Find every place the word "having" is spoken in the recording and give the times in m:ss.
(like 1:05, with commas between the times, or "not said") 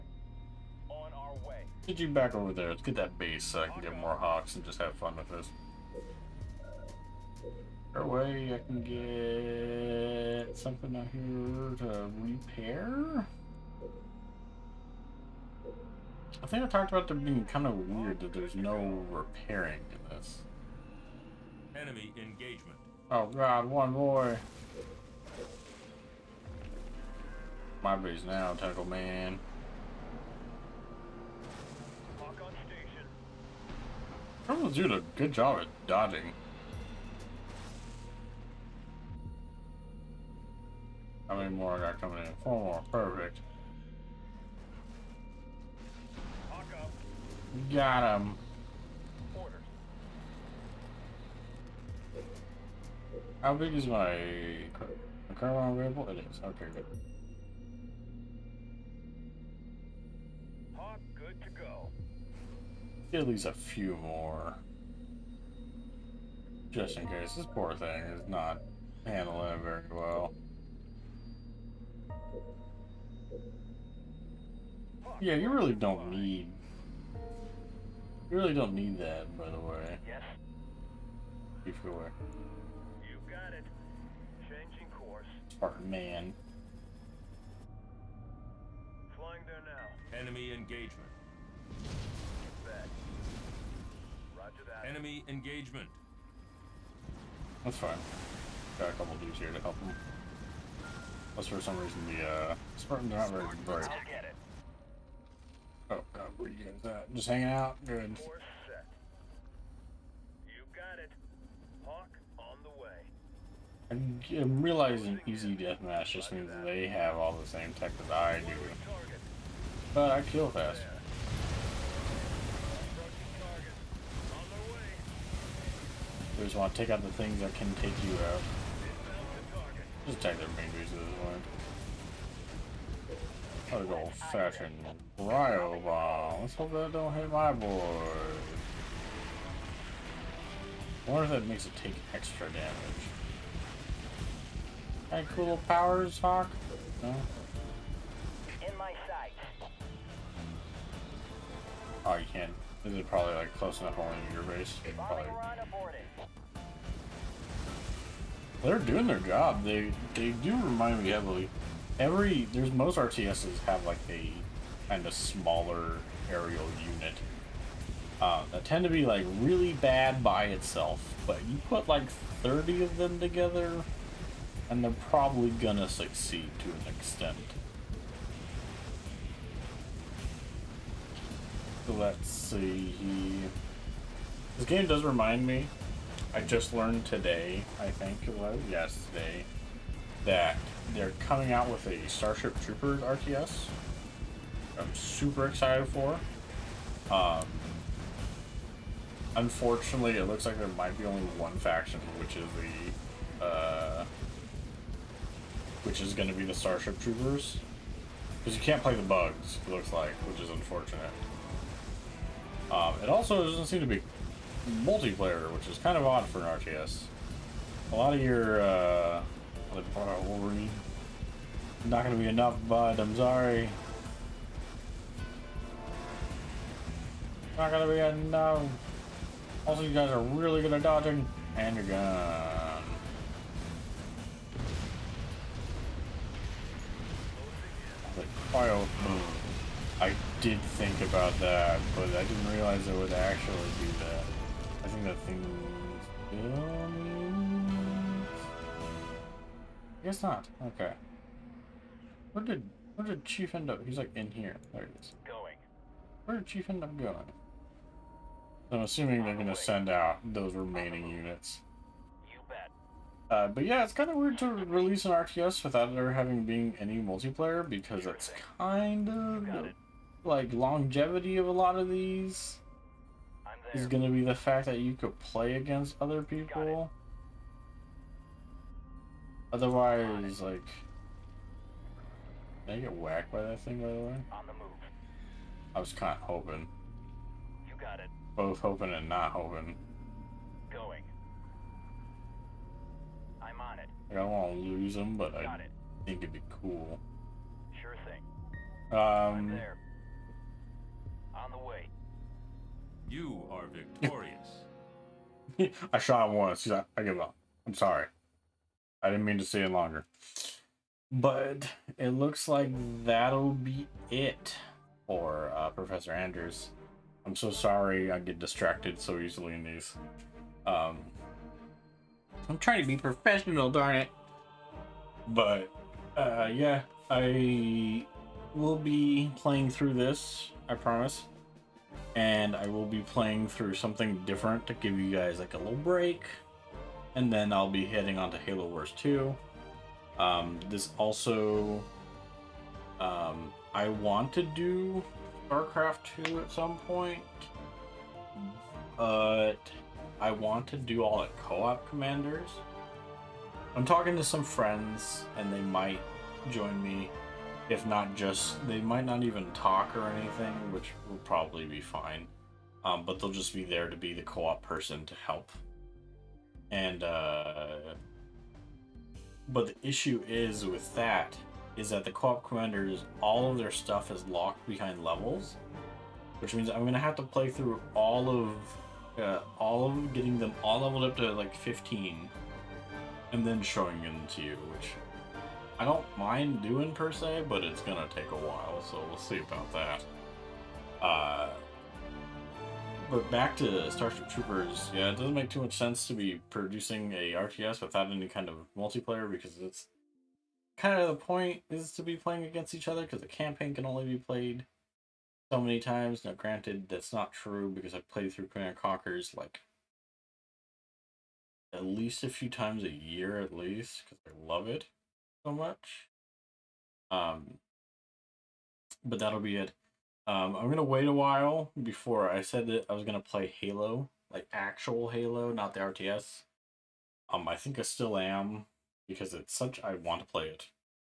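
4:26.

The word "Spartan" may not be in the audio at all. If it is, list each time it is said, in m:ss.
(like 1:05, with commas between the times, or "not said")
1:25, 1:42.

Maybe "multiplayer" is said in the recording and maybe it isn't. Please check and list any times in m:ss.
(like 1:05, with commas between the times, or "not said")
3:34, 4:26, 6:38.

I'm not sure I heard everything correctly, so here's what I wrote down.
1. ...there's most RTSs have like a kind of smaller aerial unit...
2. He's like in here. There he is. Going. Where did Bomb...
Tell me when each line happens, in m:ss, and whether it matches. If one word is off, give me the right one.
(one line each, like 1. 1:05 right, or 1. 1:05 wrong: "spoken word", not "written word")
1. 2:42 right
2. 4:13 wrong: "Chief", not "Bomb".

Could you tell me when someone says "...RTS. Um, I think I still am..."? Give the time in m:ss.
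7:05.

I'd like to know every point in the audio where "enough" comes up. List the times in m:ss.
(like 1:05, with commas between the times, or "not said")
2:33, 3:42, 3:47.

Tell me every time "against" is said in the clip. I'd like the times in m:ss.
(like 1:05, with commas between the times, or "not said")
4:35, 6:42.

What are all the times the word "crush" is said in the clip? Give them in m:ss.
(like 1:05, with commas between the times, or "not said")
not said.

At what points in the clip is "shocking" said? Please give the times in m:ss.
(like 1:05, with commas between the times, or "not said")
not said.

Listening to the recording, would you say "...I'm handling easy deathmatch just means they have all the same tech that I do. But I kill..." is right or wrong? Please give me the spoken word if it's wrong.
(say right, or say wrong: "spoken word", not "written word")
wrong: "realizing", not "handling".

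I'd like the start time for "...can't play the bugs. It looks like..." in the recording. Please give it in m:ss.
3:28.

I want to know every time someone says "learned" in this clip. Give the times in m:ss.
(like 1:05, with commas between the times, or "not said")
3:06.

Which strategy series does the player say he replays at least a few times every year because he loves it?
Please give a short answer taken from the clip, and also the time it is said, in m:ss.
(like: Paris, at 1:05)
Command & Conquer, at 6:48.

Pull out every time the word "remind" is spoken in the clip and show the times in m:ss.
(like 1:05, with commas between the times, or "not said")
2:40, 3:05.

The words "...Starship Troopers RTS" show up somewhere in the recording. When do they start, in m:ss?
3:12.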